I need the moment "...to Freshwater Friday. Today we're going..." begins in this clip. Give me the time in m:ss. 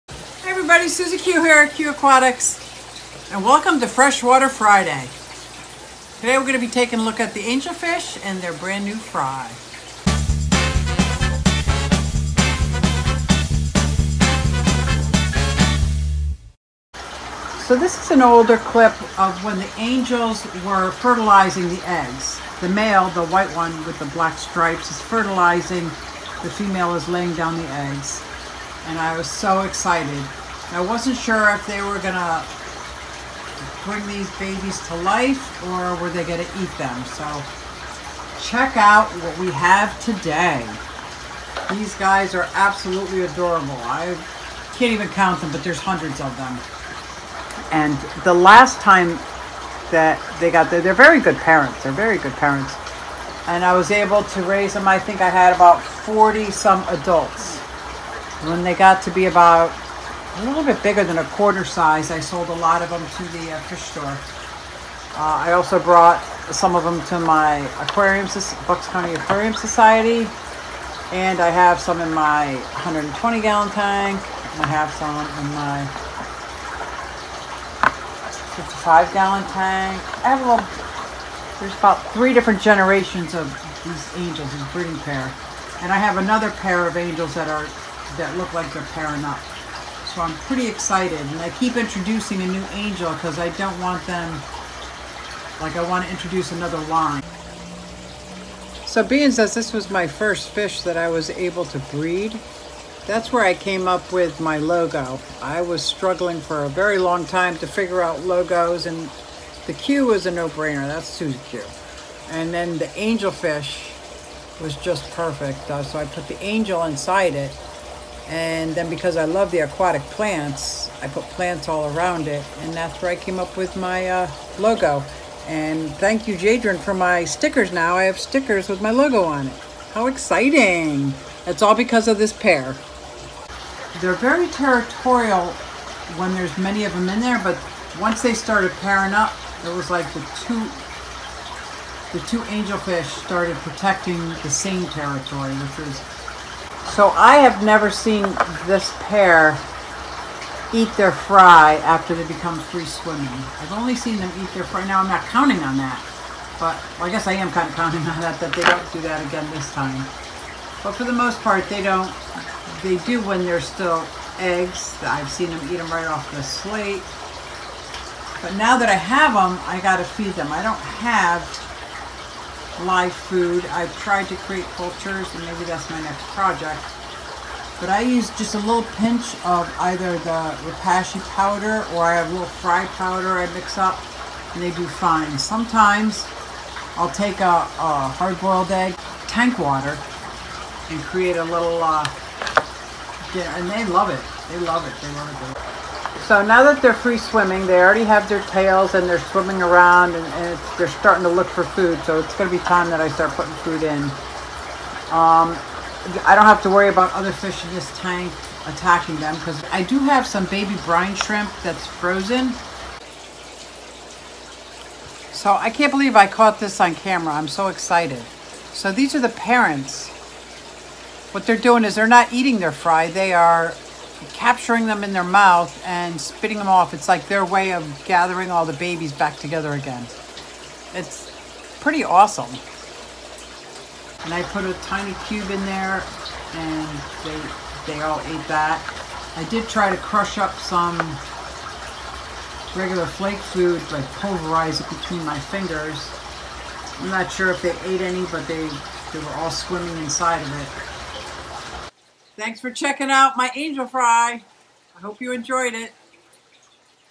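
0:03.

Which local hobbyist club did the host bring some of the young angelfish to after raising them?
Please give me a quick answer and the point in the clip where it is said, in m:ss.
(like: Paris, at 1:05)
Bucks County Aquarium Society, at 1:08.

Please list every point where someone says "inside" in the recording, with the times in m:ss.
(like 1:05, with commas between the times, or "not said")
1:56, 4:10.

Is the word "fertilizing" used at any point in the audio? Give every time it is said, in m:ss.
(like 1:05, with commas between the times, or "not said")
0:20, 0:25.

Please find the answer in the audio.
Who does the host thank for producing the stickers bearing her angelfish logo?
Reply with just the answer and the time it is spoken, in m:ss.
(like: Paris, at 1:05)
Jadron, at 2:06.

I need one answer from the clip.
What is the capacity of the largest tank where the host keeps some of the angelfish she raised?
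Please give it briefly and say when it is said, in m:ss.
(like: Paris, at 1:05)
120 gallon, at 1:12.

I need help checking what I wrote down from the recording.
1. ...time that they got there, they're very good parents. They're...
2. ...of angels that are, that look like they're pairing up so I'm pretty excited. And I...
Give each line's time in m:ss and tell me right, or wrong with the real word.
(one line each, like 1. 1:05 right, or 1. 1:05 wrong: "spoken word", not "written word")
1. 0:48 right
2. 1:26 right.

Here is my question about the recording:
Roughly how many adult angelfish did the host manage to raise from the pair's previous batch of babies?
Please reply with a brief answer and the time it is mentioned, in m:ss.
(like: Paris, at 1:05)
40, at 0:55.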